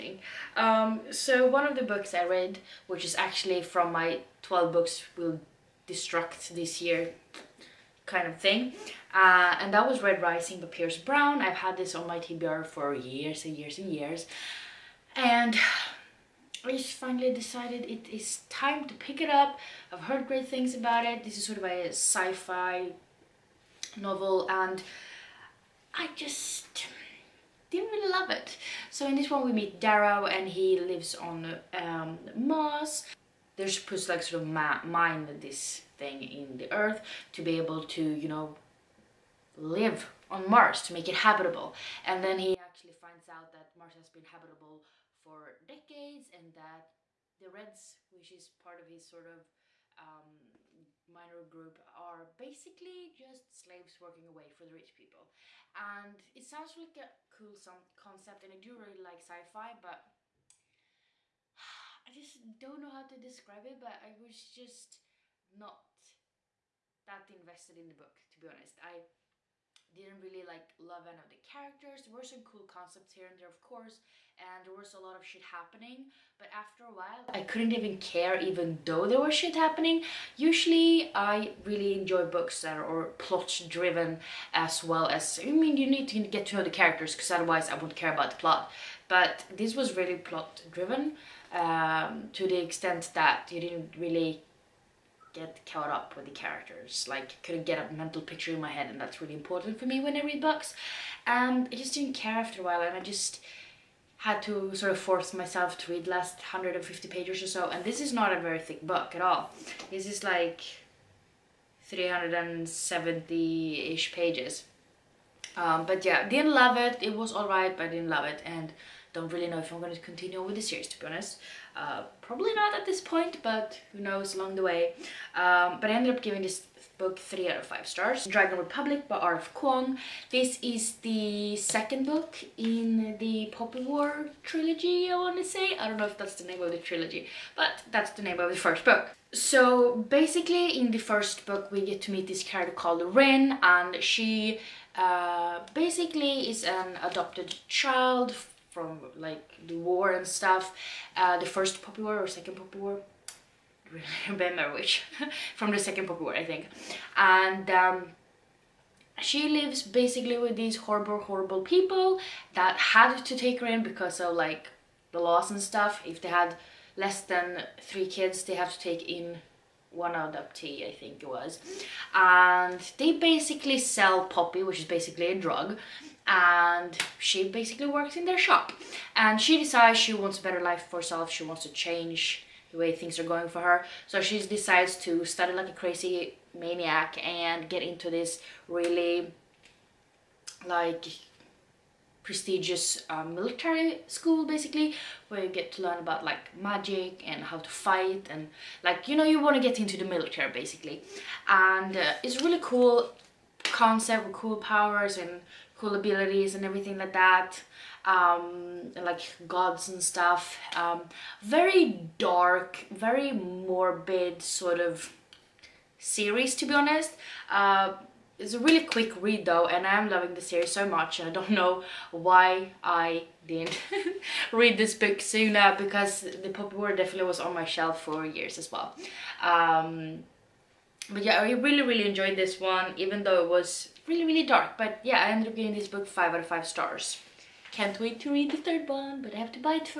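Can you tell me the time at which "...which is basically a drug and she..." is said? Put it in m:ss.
2:54.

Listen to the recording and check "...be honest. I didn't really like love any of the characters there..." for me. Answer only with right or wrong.
right.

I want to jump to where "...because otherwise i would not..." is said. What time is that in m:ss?
1:27.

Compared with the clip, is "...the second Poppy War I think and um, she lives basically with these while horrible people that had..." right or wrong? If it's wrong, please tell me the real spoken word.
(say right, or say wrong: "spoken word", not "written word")
wrong: "horrible", not "while".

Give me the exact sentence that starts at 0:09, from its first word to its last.
Uh, and that was Red Rising by Pierce Brown.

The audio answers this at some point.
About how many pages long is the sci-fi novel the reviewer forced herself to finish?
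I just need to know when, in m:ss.
1:51.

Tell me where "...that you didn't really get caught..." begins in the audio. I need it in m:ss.
1:33.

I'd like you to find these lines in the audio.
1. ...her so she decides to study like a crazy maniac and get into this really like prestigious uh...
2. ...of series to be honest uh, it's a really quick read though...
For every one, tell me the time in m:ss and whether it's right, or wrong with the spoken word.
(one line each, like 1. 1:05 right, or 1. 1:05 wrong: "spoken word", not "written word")
1. 3:03 right
2. 3:34 right.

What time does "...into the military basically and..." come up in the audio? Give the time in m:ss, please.
3:19.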